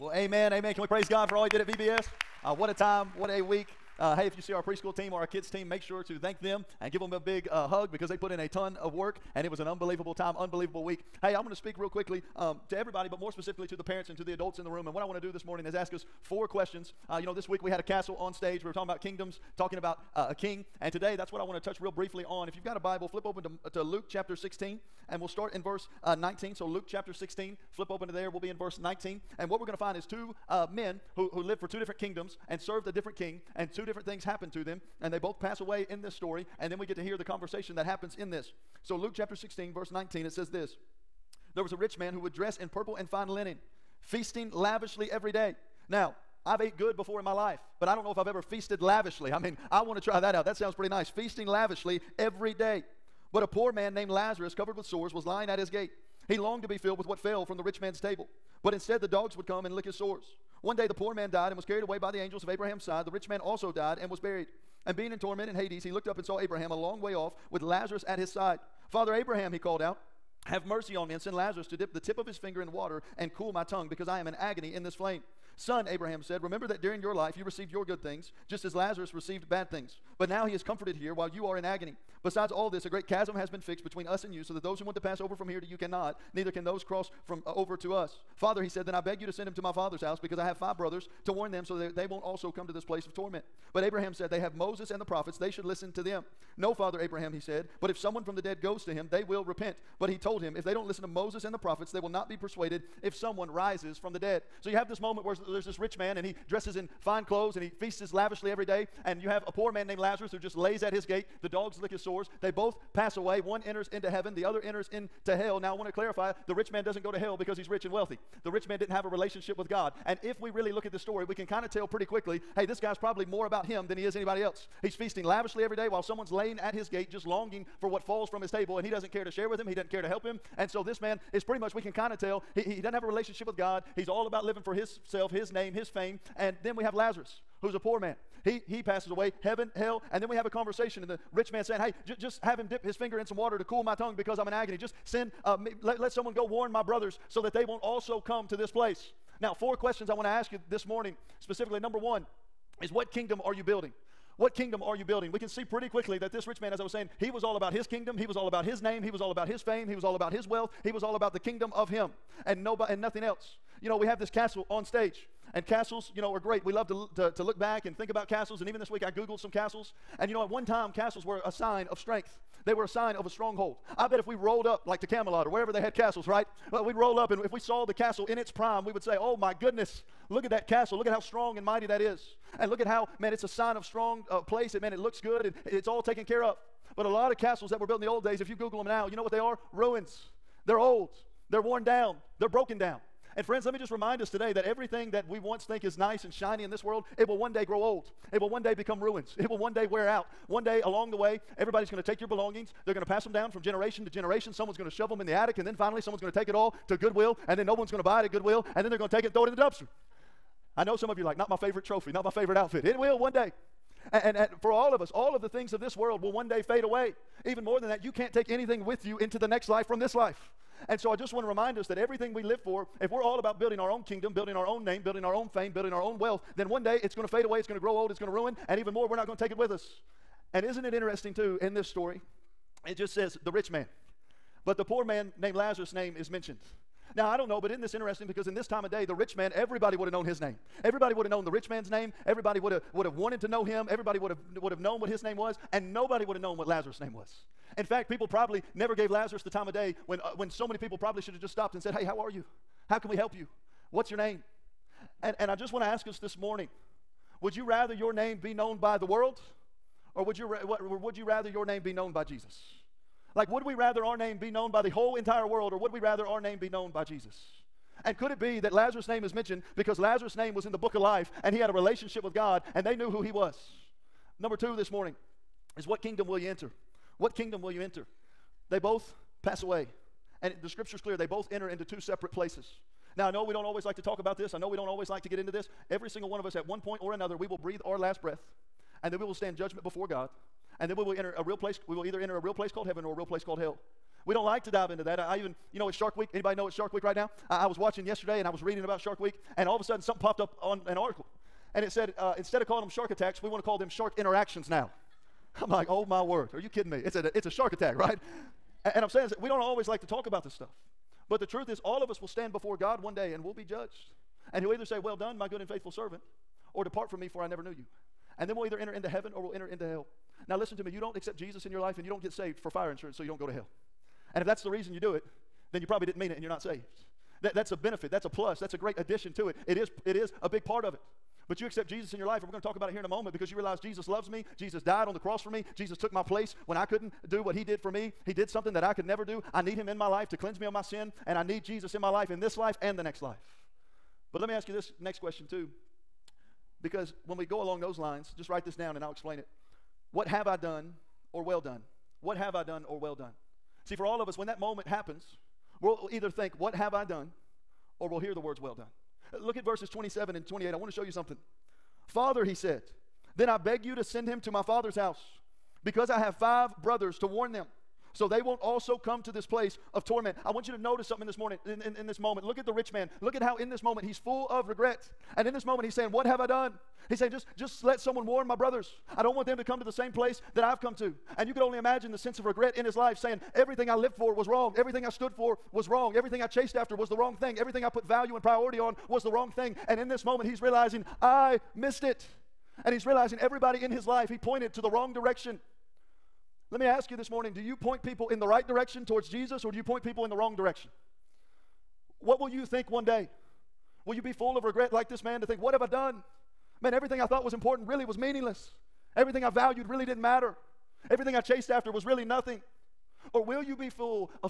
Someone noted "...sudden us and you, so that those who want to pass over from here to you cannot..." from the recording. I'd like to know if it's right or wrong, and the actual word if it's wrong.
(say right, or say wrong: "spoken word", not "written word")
wrong: "between", not "sudden".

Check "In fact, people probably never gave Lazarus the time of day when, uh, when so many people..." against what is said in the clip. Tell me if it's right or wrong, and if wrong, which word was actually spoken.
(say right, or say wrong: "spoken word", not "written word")
right.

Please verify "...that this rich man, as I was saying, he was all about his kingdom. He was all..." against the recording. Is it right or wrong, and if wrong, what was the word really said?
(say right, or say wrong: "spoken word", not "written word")
right.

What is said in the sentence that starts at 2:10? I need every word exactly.
And so this man is pretty much, we can kind of tell, he, he doesn't have a relationship with God.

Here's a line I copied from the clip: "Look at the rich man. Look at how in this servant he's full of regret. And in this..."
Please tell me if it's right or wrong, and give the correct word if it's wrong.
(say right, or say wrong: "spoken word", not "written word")
wrong: "moment", not "servant".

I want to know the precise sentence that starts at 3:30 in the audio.
I know some of you are like, not my favorite trophy, not my favorite outfit.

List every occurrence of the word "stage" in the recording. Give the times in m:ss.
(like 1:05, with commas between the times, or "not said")
0:18, 2:44.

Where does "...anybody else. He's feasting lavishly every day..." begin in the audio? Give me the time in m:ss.
2:04.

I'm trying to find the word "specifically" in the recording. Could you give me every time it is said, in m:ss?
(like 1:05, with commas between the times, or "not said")
0:13, 2:31.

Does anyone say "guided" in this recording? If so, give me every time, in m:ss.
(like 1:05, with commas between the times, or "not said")
not said.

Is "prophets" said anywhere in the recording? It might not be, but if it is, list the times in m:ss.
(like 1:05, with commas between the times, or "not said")
1:35, 1:41.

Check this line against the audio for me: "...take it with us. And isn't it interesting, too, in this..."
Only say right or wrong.
right.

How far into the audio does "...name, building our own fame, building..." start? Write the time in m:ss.
3:44.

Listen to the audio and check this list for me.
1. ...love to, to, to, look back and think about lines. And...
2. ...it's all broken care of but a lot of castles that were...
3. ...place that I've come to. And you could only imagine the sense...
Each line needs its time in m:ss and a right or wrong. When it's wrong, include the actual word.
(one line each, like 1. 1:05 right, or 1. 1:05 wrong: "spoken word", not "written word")
1. 2:46 wrong: "castles", not "lines"
2. 3:05 wrong: "taken", not "broken"
3. 6:20 right.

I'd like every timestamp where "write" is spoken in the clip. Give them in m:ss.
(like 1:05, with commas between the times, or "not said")
5:48.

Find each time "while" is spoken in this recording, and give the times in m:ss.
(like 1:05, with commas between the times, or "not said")
1:21, 2:05.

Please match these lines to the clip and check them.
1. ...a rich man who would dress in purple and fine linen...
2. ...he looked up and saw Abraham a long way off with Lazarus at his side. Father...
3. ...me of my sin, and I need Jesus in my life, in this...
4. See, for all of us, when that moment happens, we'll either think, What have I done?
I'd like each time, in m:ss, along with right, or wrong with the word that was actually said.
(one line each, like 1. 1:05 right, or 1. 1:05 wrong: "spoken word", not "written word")
1. 0:41 right
2. 1:05 right
3. 5:40 right
4. 5:53 right.